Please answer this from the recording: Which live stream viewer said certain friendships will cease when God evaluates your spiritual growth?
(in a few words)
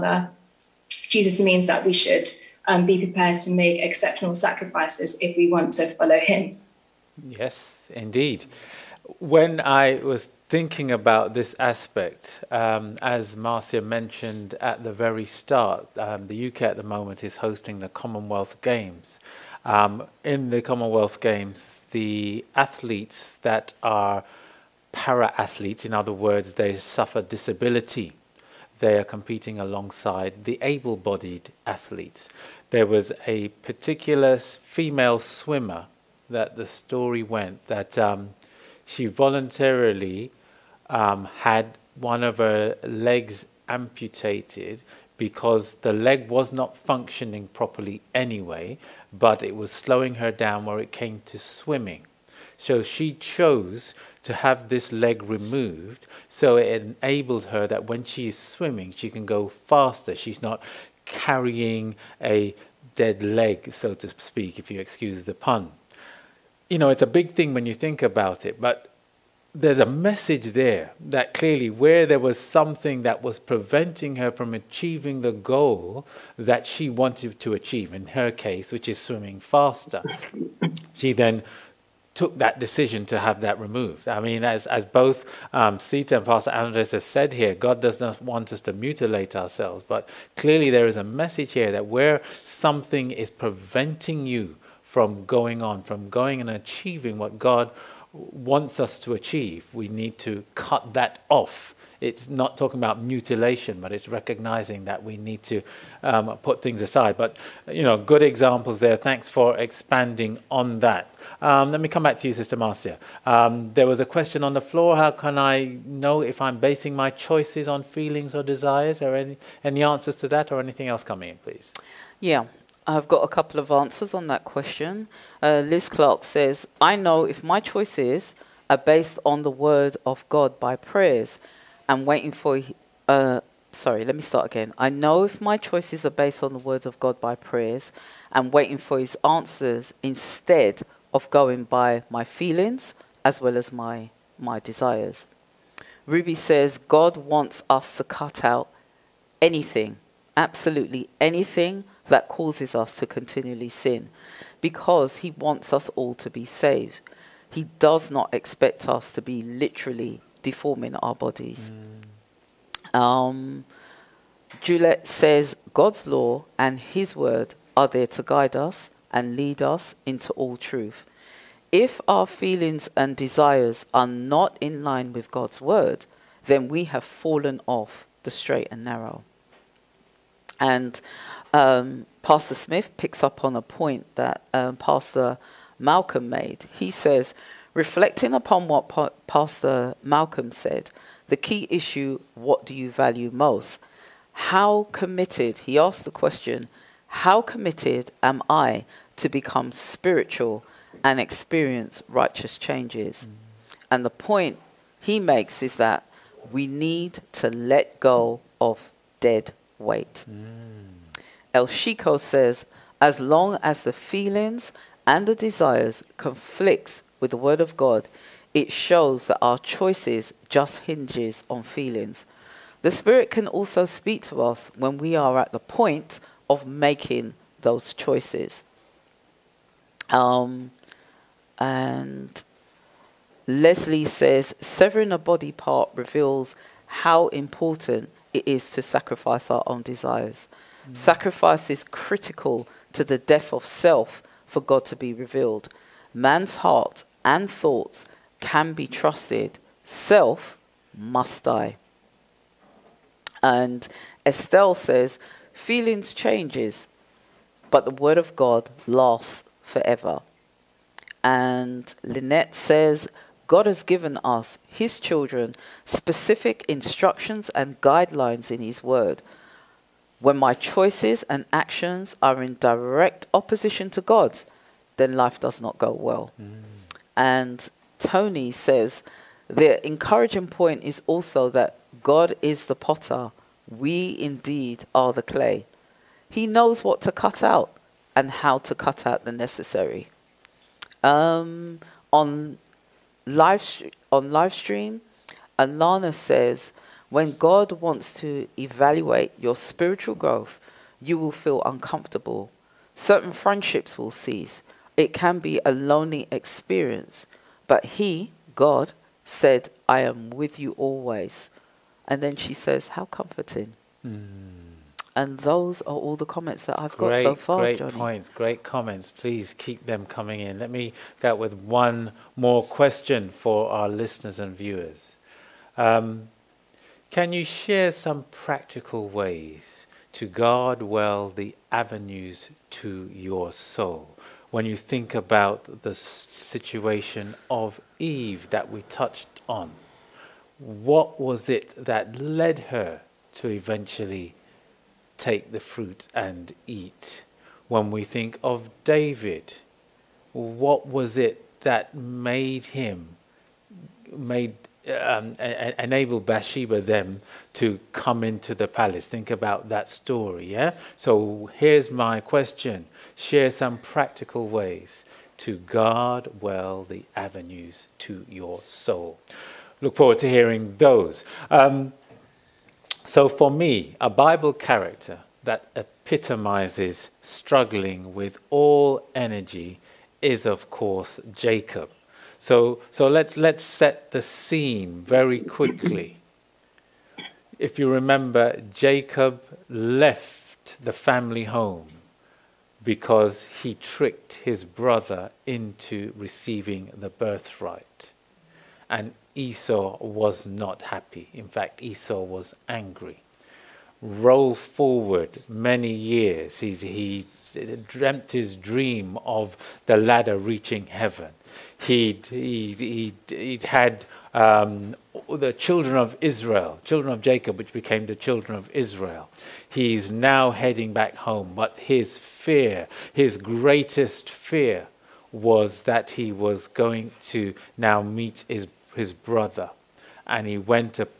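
Alana.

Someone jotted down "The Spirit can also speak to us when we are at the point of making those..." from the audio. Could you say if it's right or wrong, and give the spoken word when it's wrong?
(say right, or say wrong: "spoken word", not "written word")
right.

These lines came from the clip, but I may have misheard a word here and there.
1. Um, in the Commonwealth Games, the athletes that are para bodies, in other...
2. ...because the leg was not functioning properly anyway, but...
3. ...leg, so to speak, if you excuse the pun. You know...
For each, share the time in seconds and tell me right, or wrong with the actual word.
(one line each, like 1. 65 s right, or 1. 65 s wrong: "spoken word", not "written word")
1. 19 s wrong: "athletes", not "bodies"
2. 45 s right
3. 63 s right.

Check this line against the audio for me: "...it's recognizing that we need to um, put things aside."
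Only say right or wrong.
right.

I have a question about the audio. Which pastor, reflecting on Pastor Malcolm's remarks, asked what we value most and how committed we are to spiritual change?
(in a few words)
Pastor Smith.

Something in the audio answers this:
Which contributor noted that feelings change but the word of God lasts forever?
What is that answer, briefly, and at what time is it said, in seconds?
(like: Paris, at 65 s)
Estelle, at 254 s.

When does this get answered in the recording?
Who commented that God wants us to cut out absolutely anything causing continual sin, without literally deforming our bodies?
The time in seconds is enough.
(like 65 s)
146 s.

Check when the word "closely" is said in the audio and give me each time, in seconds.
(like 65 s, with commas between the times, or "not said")
not said.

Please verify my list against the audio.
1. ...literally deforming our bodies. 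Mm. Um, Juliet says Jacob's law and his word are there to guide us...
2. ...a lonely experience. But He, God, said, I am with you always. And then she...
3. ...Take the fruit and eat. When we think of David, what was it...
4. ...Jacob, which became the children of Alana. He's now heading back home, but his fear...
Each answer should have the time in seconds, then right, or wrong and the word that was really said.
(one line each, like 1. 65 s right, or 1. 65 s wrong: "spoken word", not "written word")
1. 159 s wrong: "God", not "Jacob"
2. 305 s right
3. 345 s right
4. 417 s wrong: "Israel", not "Alana".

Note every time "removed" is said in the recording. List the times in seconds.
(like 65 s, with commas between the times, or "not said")
55 s, 83 s.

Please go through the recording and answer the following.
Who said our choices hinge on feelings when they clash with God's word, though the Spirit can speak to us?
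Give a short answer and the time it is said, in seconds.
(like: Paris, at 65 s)
El Chico, at 211 s.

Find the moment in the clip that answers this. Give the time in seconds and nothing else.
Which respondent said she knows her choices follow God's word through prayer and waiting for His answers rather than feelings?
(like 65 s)
125 s.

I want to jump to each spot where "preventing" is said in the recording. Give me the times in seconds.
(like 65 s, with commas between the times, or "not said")
73 s, 93 s.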